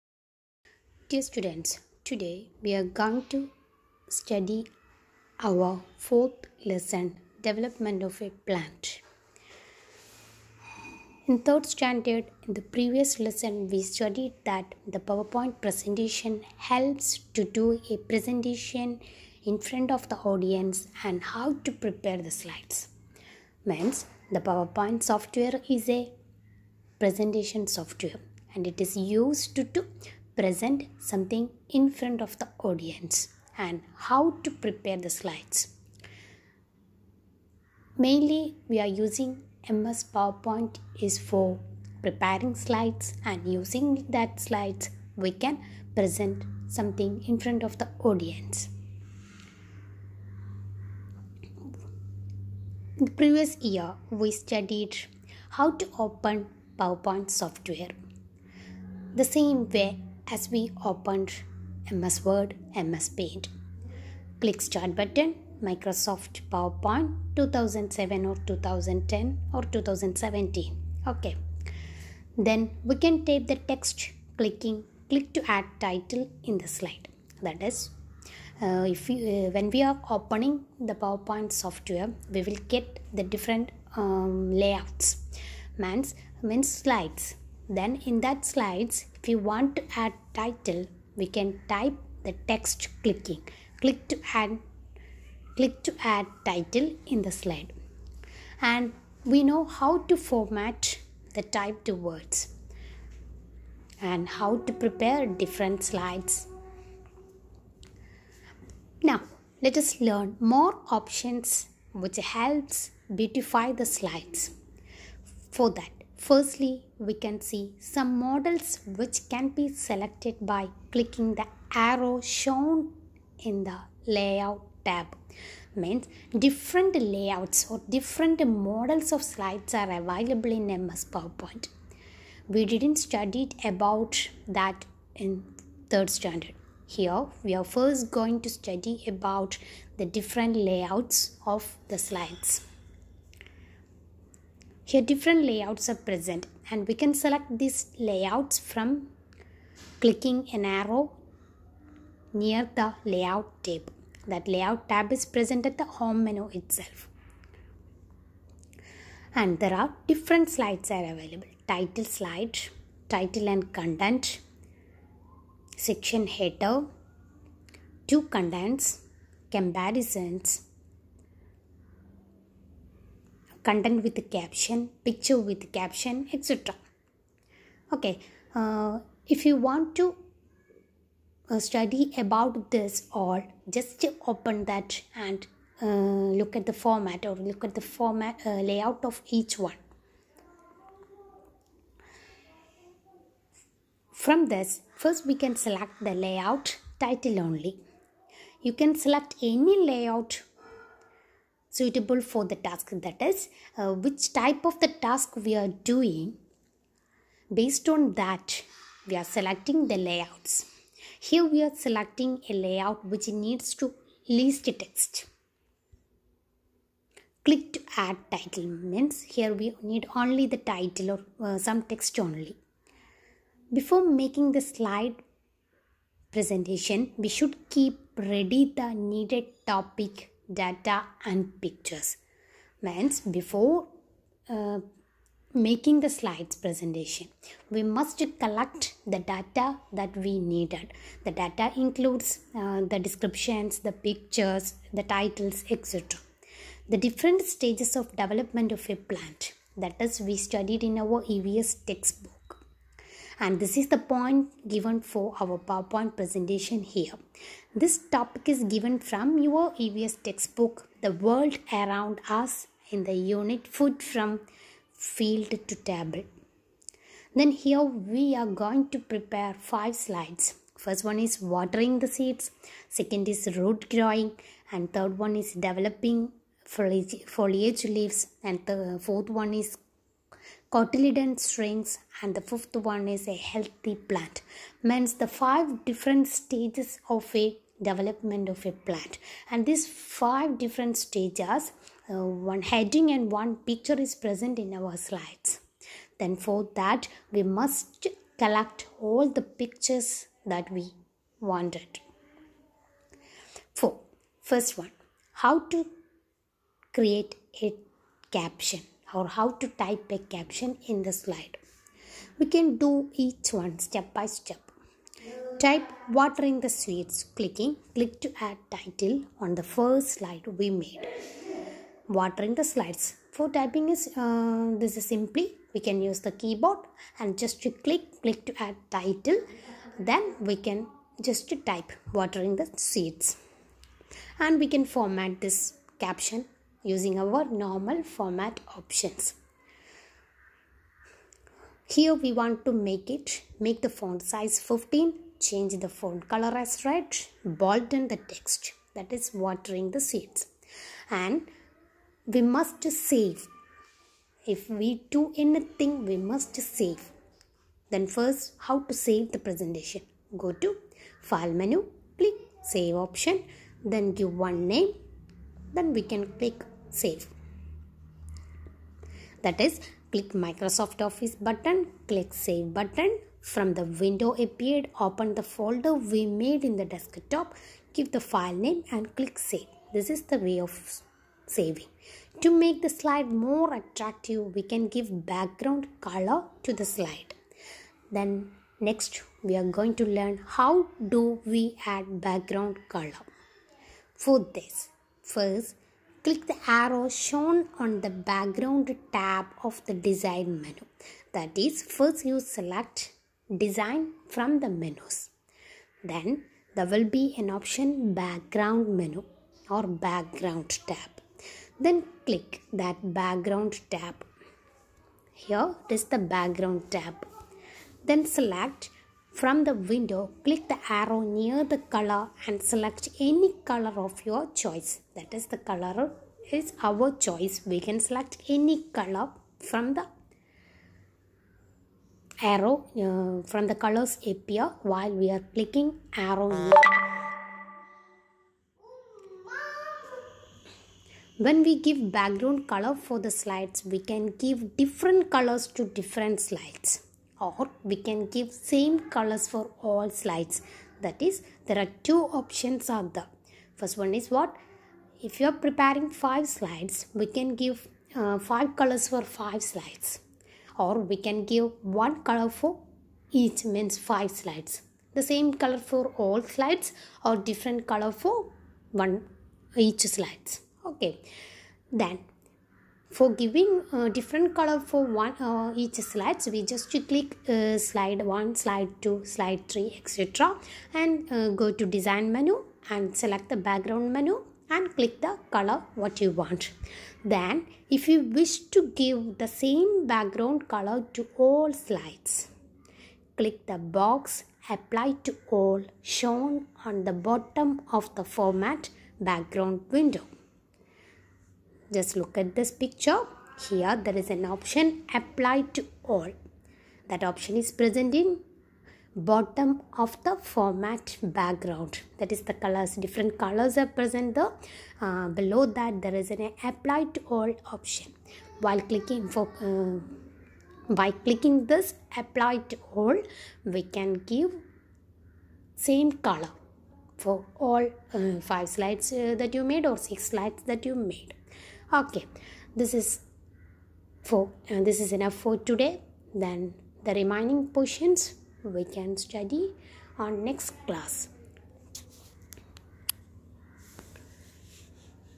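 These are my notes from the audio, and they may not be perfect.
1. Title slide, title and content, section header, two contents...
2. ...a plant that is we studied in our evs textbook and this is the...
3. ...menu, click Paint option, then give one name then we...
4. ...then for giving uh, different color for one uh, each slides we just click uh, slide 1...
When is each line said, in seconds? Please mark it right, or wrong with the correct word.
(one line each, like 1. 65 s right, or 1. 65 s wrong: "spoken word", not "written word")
1. 161 s right
2. 248 s right
3. 361 s wrong: "Save", not "Paint"
4. 472 s right.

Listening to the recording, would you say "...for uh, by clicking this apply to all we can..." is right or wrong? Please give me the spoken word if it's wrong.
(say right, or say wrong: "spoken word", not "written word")
right.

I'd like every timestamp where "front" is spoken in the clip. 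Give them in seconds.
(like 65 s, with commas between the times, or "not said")
19 s, 31 s, 47 s.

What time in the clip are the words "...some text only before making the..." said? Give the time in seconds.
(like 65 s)
221 s.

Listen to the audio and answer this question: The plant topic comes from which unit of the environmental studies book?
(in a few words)
Food from Field to Table.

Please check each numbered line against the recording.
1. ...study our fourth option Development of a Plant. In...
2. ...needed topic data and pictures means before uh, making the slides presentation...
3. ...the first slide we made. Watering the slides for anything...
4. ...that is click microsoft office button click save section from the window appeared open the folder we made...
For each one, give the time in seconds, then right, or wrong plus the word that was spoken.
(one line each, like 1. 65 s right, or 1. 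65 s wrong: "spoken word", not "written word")
1. 4 s wrong: "lesson", not "option"
2. 229 s right
3. 319 s wrong: "typing", not "anything"
4. 369 s wrong: "button", not "section".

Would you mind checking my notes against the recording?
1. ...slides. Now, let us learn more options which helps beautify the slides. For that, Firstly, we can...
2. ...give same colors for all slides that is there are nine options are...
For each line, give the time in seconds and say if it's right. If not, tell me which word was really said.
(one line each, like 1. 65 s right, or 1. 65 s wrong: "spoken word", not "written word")
1. 105 s right
2. 448 s wrong: "two", not "nine".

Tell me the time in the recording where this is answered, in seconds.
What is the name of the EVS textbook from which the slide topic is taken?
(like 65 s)
261 s.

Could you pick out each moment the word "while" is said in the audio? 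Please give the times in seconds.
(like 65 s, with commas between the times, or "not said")
434 s, 518 s.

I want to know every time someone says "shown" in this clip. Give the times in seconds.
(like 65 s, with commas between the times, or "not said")
122 s, 397 s, 496 s.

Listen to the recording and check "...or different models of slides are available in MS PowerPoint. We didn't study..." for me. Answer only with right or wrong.
right.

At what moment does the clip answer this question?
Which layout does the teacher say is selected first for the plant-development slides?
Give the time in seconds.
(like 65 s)
196 s.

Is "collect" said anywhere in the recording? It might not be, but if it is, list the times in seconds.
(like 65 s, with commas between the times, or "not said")
238 s, 298 s.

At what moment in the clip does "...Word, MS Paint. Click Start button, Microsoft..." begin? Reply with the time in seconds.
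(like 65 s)
62 s.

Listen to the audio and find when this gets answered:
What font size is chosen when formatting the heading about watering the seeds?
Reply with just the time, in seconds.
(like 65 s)
344 s.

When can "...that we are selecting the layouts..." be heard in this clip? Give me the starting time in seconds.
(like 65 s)
208 s.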